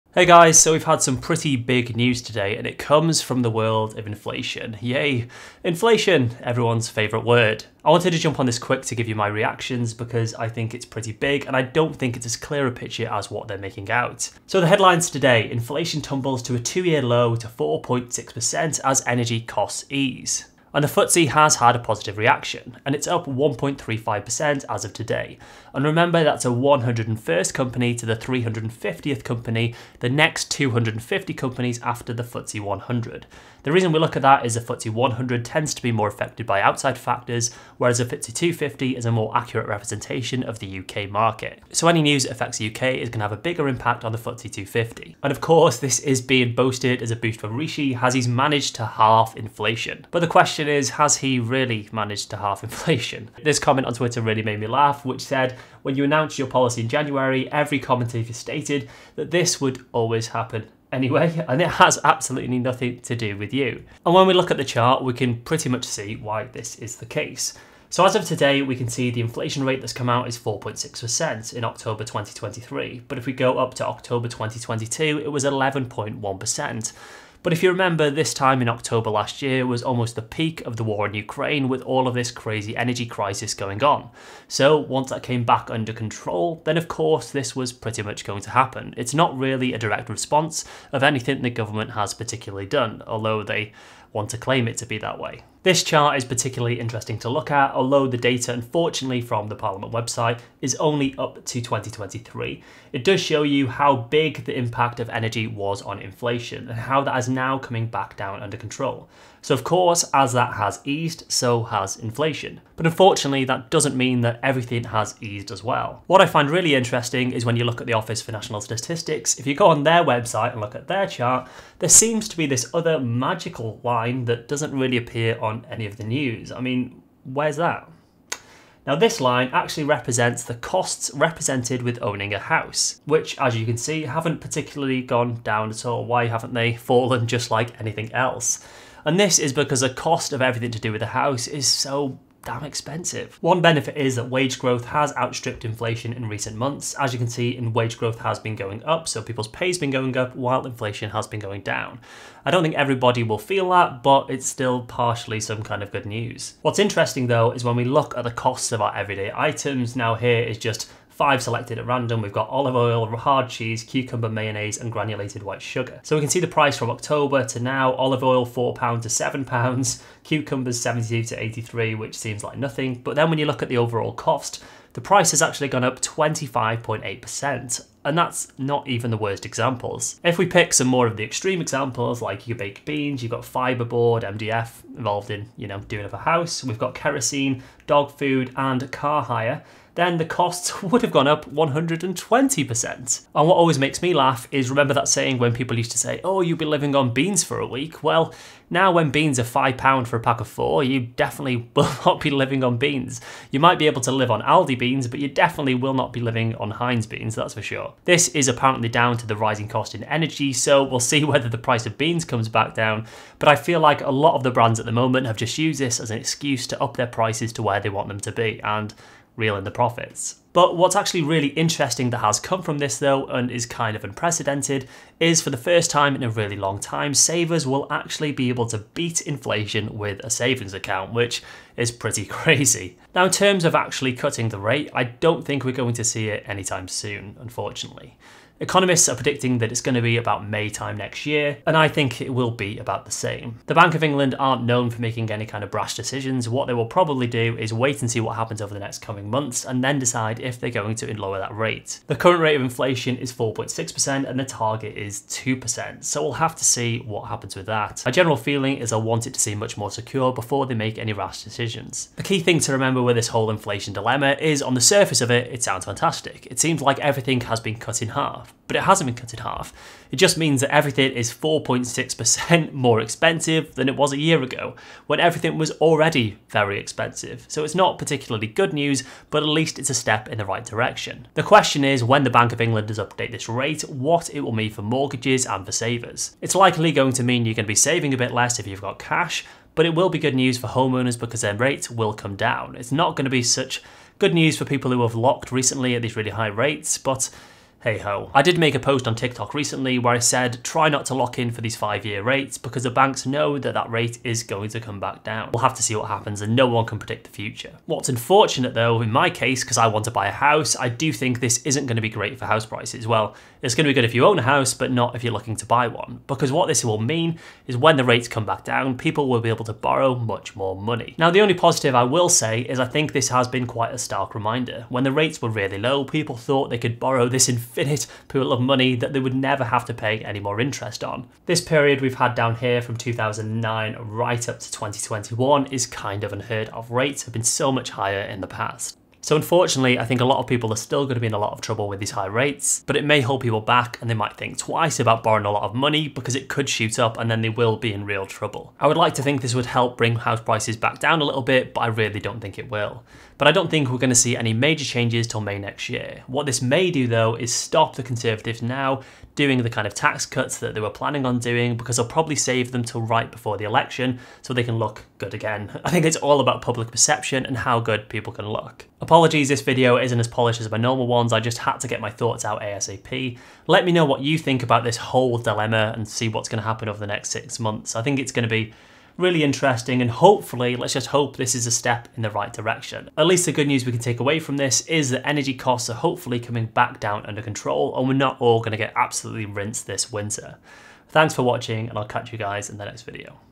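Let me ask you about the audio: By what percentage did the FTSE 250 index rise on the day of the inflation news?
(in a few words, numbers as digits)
1.35%.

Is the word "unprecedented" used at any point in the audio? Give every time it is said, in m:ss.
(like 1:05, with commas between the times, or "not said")
3:44.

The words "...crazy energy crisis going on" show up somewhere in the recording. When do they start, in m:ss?
1:22.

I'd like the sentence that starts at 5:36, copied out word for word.
Rates have been so much higher in the past.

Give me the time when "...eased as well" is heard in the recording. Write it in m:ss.
1:55.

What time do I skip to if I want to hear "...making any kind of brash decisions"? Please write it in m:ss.
4:05.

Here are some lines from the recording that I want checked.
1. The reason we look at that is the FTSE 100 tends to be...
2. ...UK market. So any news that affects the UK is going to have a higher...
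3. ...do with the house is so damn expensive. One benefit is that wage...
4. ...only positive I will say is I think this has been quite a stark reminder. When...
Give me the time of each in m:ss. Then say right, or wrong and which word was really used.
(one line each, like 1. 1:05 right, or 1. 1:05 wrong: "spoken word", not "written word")
1. 0:33 right
2. 0:40 wrong: "bigger", not "higher"
3. 2:20 right
4. 5:21 right.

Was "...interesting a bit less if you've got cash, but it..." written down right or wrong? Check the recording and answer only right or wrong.
wrong.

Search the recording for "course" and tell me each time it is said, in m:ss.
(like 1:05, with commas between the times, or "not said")
0:45, 1:26, 1:49.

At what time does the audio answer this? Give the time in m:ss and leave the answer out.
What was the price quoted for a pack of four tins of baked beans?
3:19.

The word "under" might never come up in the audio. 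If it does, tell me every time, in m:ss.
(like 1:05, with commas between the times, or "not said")
1:25, 1:48, 6:27.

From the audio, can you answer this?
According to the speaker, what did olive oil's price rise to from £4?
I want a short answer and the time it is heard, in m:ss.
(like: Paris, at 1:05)
£7, at 2:49.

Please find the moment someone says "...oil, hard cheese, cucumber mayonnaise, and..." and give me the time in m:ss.
2:42.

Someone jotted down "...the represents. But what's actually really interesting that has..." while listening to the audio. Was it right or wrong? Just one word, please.
wrong.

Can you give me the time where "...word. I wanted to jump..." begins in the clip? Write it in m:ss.
0:07.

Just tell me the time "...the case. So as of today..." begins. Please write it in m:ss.
1:06.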